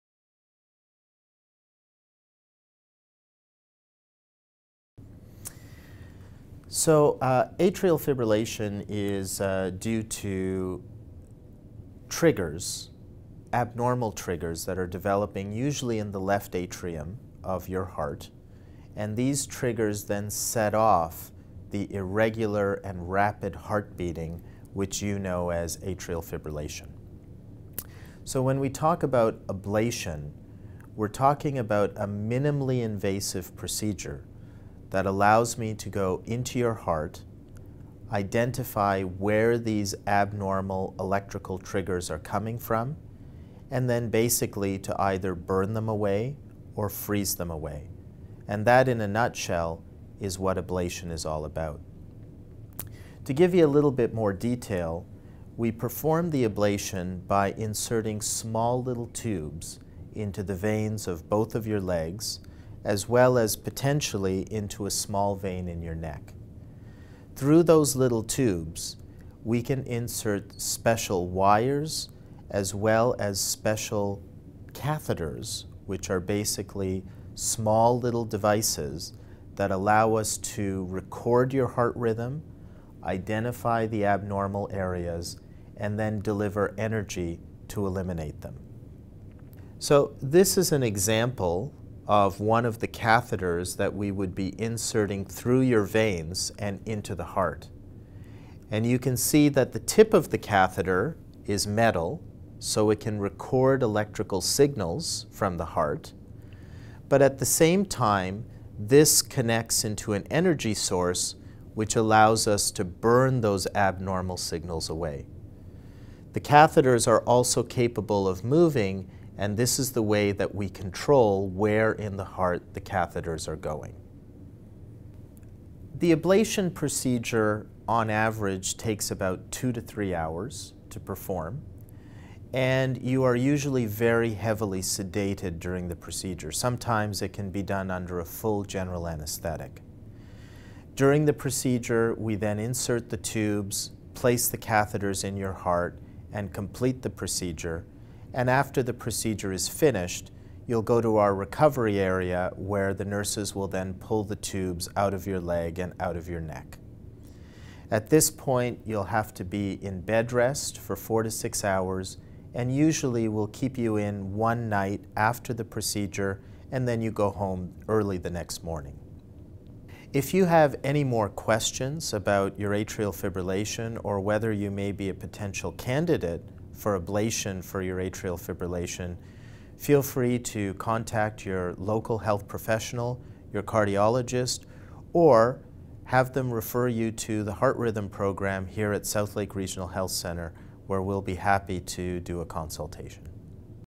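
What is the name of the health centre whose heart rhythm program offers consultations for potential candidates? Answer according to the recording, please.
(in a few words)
Southlake Regional Health Center.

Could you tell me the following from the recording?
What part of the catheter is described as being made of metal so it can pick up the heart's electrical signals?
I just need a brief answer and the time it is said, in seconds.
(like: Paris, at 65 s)
the tip, at 99 s.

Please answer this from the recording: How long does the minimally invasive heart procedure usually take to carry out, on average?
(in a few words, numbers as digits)
2 to 3 hours.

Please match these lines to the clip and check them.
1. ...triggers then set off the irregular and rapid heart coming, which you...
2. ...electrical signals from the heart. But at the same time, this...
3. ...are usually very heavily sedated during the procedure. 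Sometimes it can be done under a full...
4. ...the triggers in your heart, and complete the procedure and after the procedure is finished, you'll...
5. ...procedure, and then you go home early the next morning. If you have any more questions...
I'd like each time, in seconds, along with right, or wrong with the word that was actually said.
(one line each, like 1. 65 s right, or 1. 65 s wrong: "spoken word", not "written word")
1. 19 s wrong: "beating", not "coming"
2. 103 s right
3. 133 s right
4. 144 s wrong: "catheters", not "triggers"
5. 165 s right.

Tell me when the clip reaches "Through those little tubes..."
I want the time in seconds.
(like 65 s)
67 s.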